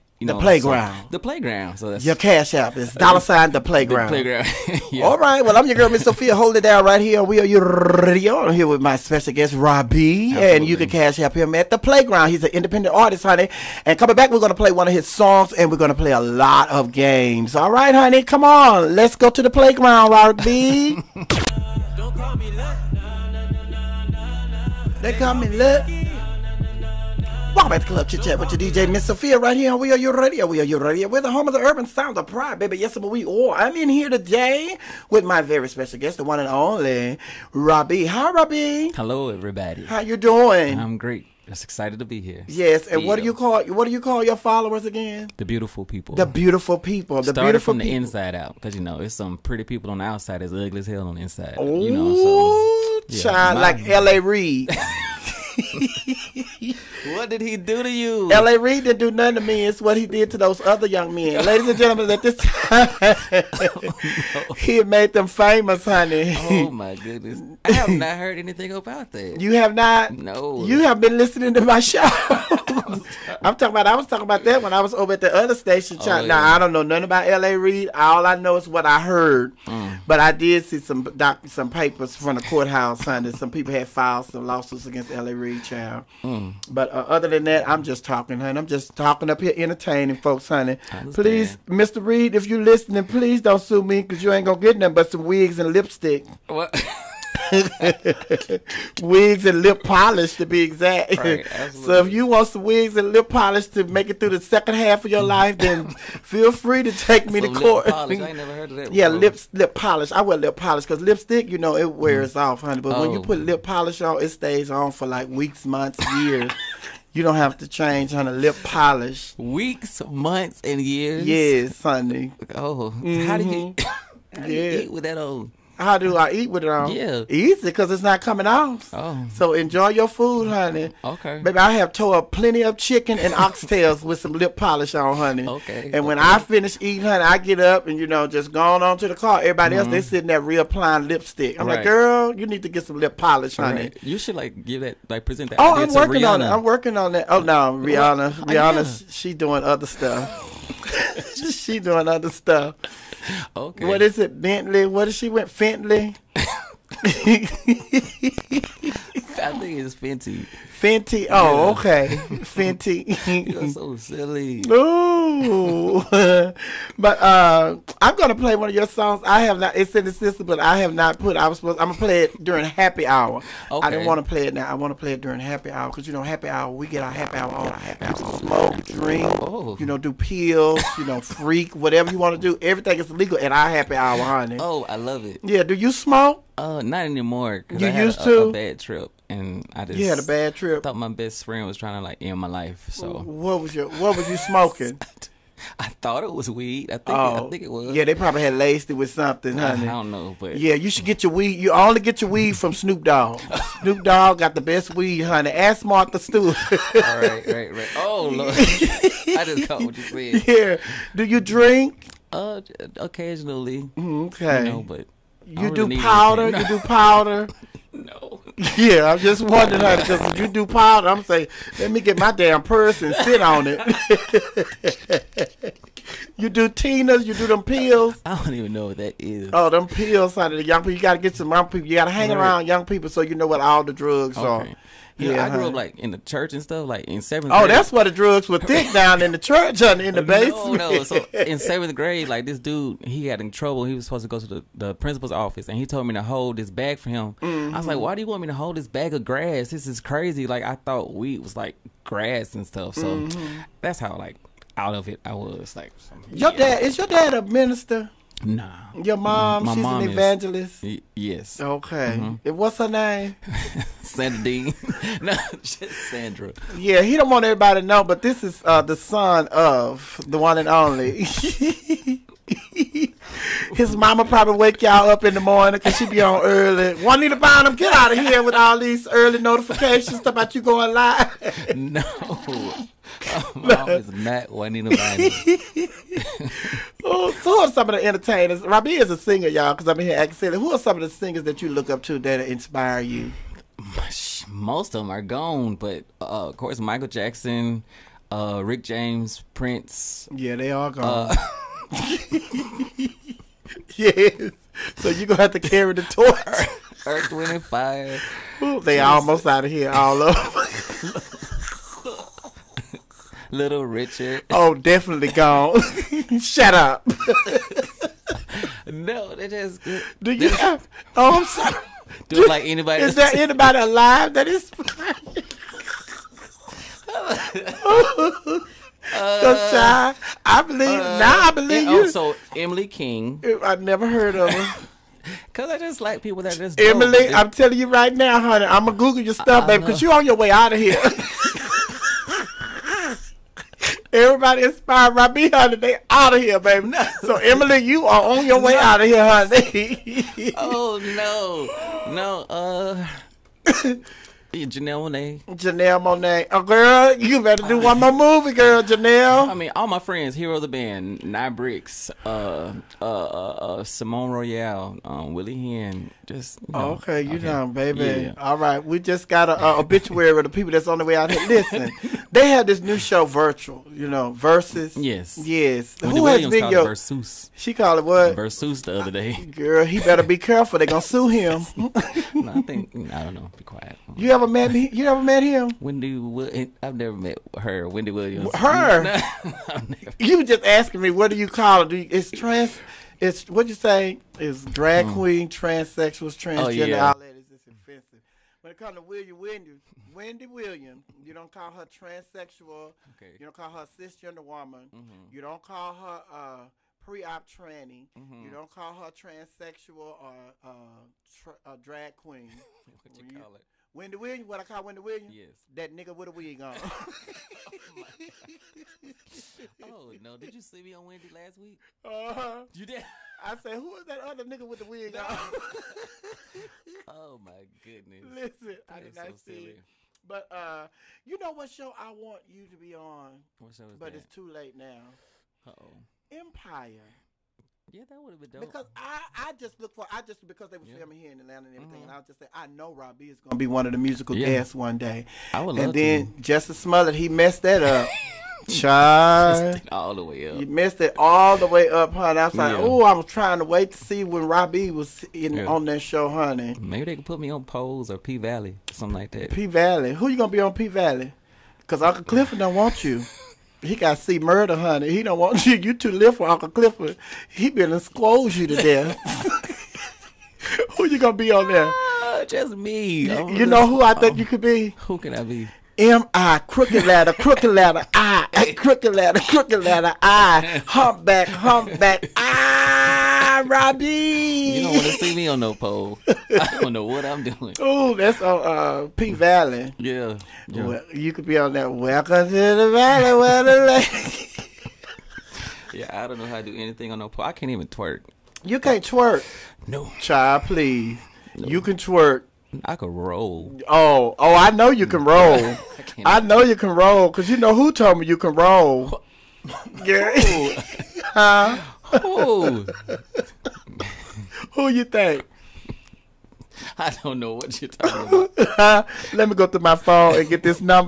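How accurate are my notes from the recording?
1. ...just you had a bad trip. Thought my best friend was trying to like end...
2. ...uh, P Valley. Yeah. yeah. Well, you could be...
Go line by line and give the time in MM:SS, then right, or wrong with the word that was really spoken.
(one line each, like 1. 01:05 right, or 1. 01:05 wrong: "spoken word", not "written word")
1. 03:09 right
2. 08:08 right.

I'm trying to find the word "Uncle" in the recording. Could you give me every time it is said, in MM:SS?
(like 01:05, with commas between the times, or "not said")
07:41, 07:46.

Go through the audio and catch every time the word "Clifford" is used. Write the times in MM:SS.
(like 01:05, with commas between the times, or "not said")
07:42, 07:46.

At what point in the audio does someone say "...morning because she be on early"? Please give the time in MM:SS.
04:35.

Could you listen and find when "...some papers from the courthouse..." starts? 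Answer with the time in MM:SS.
01:21.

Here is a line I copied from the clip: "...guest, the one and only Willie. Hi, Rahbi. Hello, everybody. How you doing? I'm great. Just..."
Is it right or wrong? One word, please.
wrong.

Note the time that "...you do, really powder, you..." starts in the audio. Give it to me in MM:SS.
03:35.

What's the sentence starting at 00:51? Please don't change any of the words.
Ooh, you know, so, yeah, child, like L.A.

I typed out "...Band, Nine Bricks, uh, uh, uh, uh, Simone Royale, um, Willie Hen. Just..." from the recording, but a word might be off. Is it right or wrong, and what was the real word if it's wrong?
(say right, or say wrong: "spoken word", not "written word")
right.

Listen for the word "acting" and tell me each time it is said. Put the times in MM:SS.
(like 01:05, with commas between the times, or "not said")
04:50.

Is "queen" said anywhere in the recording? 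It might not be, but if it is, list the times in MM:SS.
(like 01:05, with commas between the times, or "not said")
06:35, 06:52.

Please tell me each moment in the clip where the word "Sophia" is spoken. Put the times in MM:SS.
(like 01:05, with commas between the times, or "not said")
00:06, 00:29.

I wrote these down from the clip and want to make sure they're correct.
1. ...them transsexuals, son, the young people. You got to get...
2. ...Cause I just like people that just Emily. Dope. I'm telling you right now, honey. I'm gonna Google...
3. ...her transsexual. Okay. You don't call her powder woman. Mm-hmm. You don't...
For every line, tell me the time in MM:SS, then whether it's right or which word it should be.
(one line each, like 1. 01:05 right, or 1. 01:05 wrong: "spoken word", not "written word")
1. 03:49 wrong: "pills", not "transsexuals"
2. 05:35 right
3. 06:41 wrong: "cisgender", not "powder".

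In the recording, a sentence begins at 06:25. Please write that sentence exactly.
Wendy, eh, I've never met her.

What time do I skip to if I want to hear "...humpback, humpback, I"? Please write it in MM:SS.
08:00.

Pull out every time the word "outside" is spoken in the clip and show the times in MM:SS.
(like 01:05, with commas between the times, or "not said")
00:50.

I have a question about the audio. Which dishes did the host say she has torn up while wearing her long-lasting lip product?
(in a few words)
Chicken and oxtails.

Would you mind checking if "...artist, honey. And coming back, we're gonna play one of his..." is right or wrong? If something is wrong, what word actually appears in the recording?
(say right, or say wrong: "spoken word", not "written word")
right.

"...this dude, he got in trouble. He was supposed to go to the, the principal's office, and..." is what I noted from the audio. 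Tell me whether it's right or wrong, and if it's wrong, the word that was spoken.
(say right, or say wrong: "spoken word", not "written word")
right.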